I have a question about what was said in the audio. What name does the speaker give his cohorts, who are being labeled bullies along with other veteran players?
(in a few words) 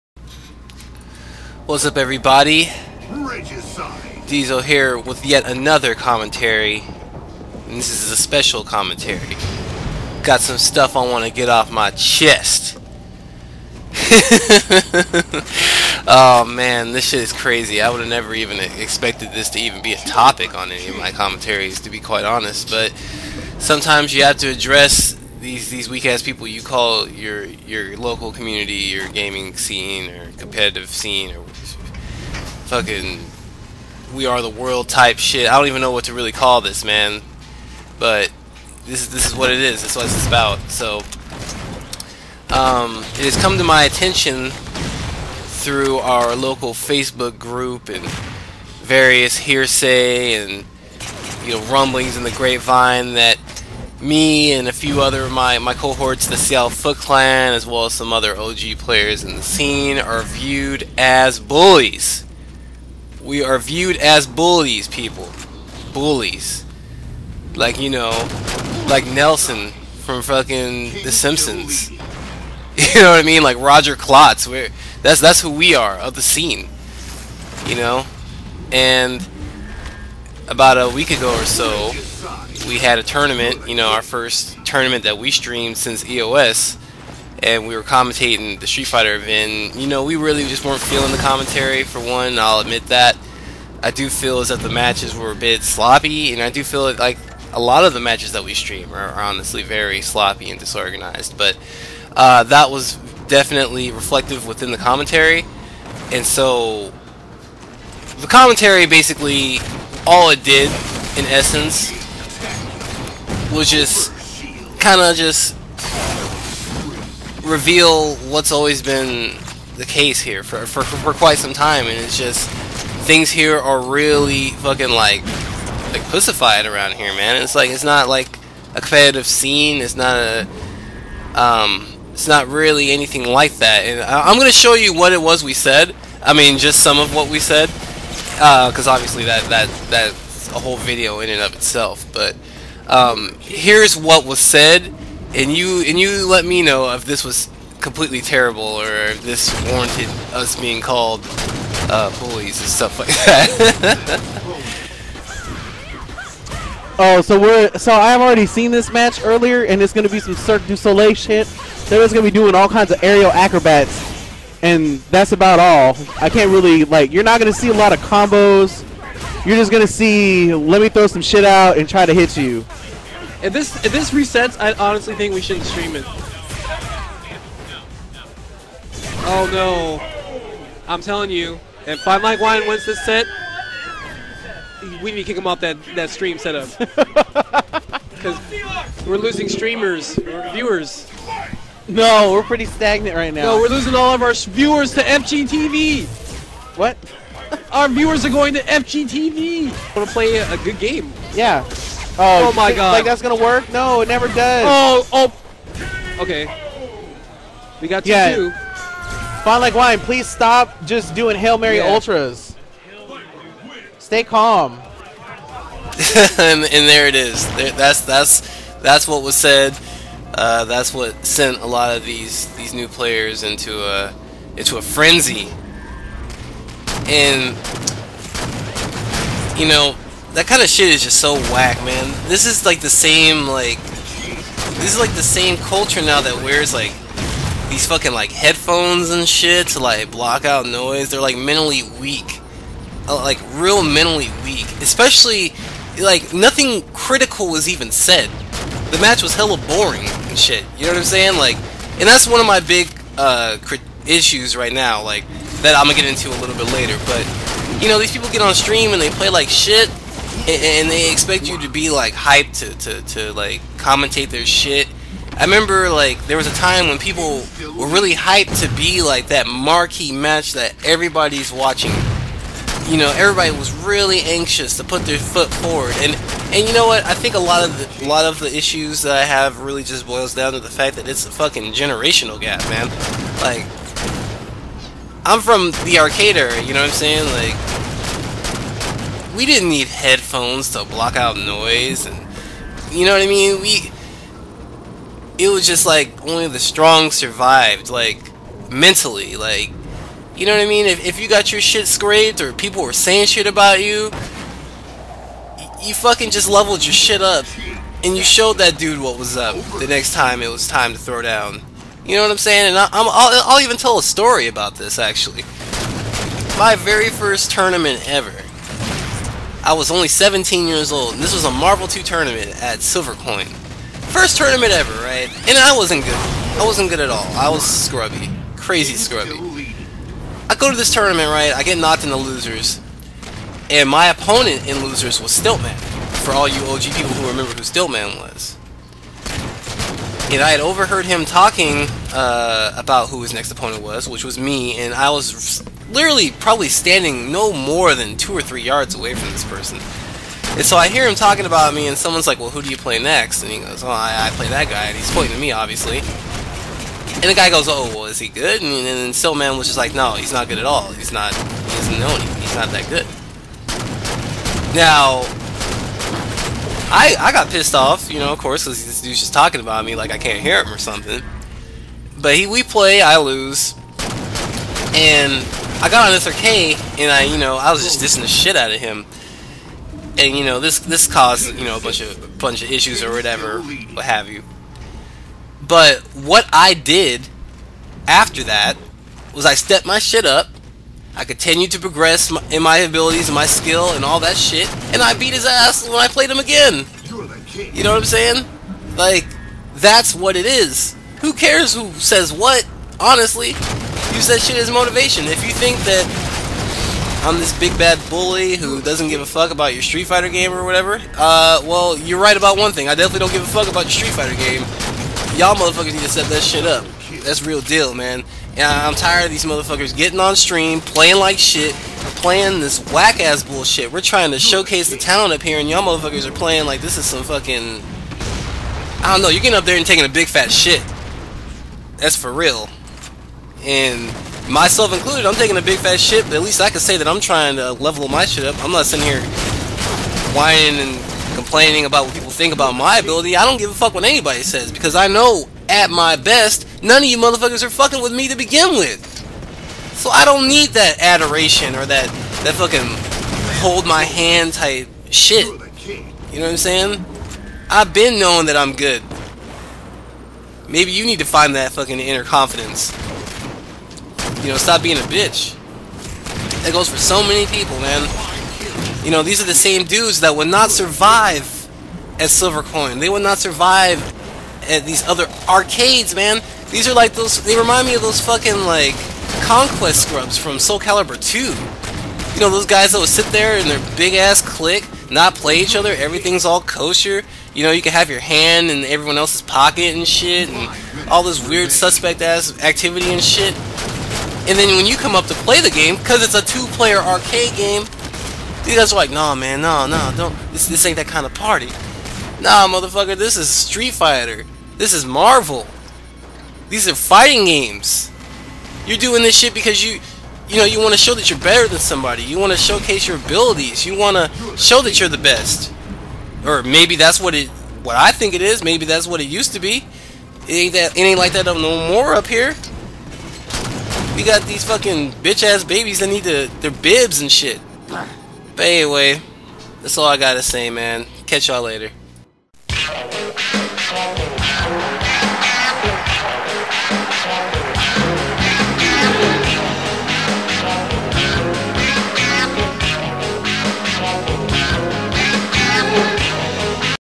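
Seattle Foot Clan.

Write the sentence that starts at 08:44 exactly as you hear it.
We got these fucking bitch ass babies that need to, their bibs and shit.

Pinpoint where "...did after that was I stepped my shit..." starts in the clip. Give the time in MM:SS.
06:26.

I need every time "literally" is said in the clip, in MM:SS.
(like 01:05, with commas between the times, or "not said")
05:45.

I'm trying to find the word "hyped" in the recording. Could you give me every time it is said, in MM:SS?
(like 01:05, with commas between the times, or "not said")
04:22, 04:28.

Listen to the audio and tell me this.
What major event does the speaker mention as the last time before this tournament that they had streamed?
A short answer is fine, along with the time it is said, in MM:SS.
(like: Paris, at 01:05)
EOS, at 01:26.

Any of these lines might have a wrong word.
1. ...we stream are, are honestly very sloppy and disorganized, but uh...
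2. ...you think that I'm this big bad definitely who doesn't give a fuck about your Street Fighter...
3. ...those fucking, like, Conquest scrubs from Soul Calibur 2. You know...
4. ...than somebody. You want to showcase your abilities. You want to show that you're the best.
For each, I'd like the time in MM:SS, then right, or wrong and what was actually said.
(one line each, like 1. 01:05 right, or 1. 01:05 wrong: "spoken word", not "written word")
1. 01:38 right
2. 06:45 wrong: "bully", not "definitely"
3. 07:58 right
4. 08:31 right.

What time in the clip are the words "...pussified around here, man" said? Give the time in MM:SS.
02:06.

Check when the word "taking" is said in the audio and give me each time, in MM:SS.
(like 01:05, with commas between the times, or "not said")
07:09, 07:15.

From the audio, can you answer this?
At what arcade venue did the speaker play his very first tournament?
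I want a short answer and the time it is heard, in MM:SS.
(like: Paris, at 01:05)
Silvercoin, at 05:22.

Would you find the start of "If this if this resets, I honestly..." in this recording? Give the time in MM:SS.
02:53.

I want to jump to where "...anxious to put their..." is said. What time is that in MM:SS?
04:34.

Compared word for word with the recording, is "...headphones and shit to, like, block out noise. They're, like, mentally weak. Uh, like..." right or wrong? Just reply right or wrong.
right.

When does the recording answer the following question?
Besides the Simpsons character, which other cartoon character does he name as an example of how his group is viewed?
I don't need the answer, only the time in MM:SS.
01:13.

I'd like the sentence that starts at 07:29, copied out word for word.
So I don't need that adoration or that, that fucking hold my hand type shit.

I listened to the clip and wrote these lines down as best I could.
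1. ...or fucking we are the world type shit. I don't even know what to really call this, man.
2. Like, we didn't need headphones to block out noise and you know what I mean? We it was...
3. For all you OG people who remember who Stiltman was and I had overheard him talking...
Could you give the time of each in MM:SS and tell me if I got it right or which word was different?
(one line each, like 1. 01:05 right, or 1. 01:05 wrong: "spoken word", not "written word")
1. 00:31 right
2. 04:47 right
3. 05:36 right.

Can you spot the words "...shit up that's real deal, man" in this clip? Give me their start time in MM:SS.
06:56.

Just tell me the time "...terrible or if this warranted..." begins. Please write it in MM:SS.
02:28.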